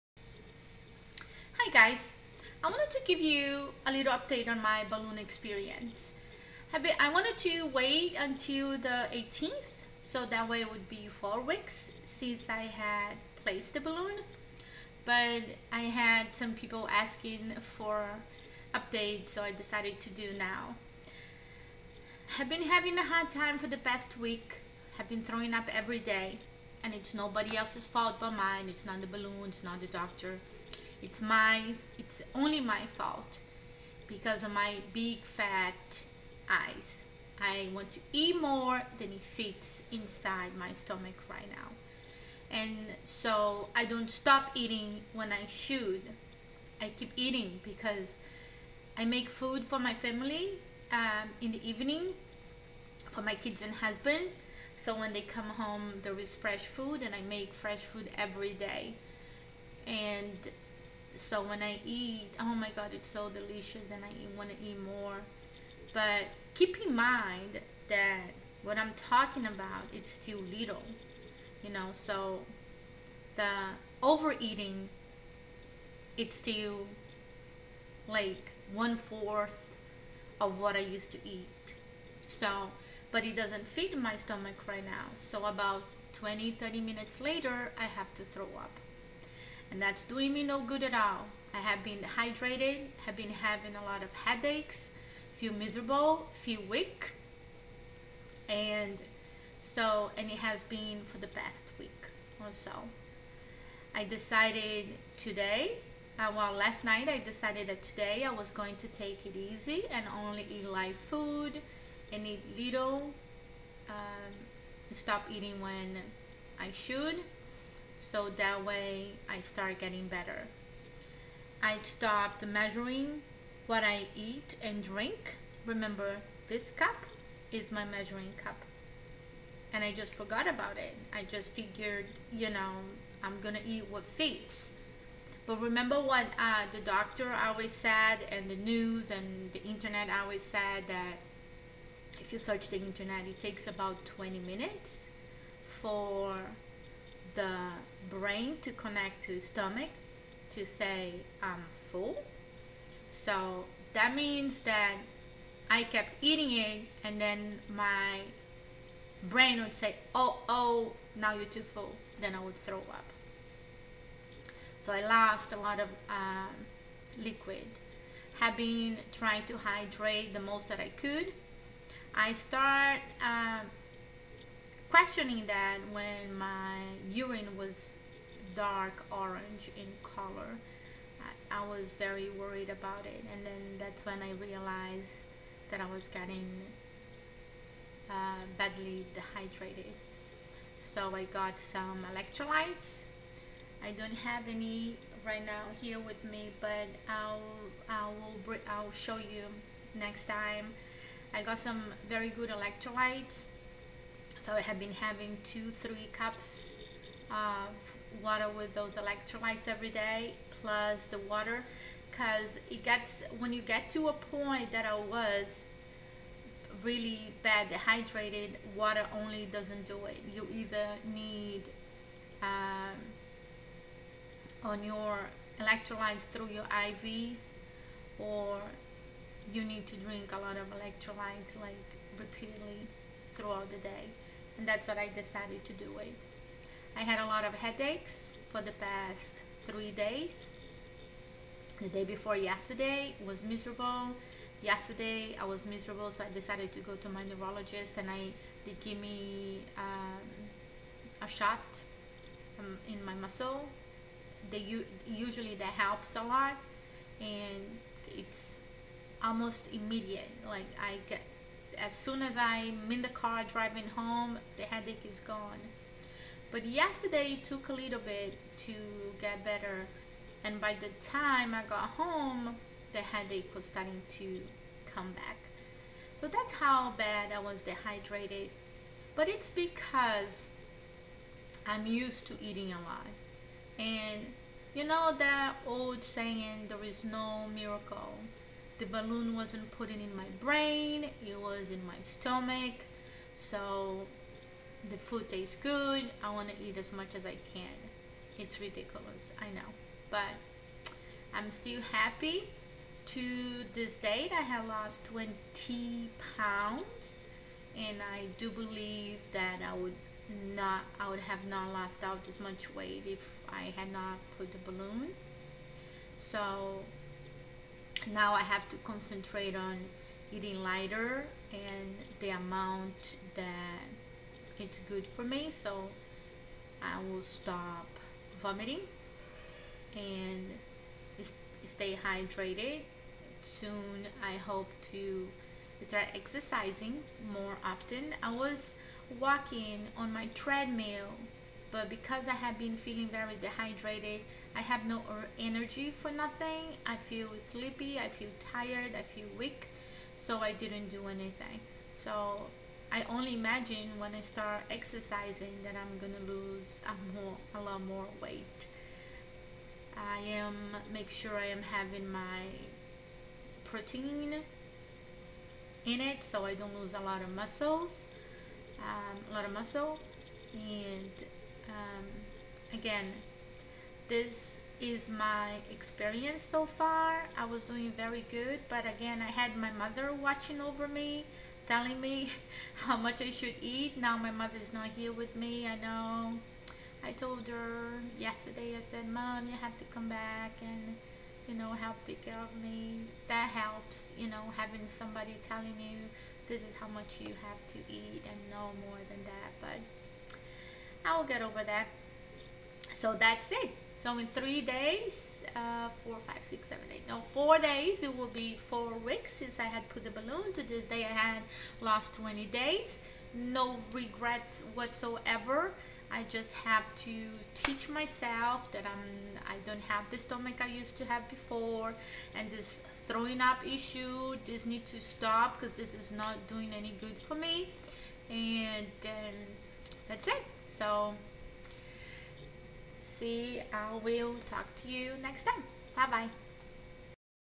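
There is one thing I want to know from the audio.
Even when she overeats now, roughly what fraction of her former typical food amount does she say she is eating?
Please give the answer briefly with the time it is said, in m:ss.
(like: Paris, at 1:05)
one fourth, at 1:18.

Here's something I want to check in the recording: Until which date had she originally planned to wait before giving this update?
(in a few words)
the 18th.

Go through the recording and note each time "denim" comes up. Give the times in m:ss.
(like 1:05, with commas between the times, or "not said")
not said.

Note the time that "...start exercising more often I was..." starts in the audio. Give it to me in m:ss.
5:35.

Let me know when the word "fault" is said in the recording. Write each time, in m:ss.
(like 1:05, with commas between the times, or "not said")
0:27, 0:32.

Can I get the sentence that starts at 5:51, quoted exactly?
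So I only imagine when I start exercising that I'm gonna lose a, more, a lot more weight.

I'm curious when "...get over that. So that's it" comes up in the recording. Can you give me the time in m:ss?
6:41.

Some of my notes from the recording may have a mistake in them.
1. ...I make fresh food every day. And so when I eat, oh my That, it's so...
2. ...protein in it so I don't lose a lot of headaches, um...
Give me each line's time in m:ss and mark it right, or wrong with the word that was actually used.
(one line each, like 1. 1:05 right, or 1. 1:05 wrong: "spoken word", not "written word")
1. 0:57 wrong: "God", not "That"
2. 6:03 wrong: "muscles", not "headaches".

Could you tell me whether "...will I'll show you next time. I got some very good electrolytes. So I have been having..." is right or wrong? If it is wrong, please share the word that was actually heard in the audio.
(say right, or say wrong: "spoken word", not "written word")
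right.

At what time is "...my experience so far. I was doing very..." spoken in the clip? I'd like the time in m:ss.
6:15.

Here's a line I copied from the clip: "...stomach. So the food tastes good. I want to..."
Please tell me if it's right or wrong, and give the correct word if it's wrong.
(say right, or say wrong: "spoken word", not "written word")
right.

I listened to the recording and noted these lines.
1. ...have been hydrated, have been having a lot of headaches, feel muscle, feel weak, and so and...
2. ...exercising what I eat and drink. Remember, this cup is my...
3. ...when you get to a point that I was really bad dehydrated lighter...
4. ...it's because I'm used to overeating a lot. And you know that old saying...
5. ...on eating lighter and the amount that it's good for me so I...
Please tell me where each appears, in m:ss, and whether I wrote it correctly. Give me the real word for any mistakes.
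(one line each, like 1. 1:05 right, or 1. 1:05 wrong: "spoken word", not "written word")
1. 1:31 wrong: "miserable", not "muscle"
2. 2:02 wrong: "measuring", not "exercising"
3. 3:33 wrong: "water", not "lighter"
4. 4:39 wrong: "eating", not "overeating"
5. 5:19 right.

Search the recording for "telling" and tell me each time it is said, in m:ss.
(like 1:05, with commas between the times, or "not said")
6:21, 6:35.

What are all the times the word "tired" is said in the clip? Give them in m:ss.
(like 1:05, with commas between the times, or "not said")
5:48.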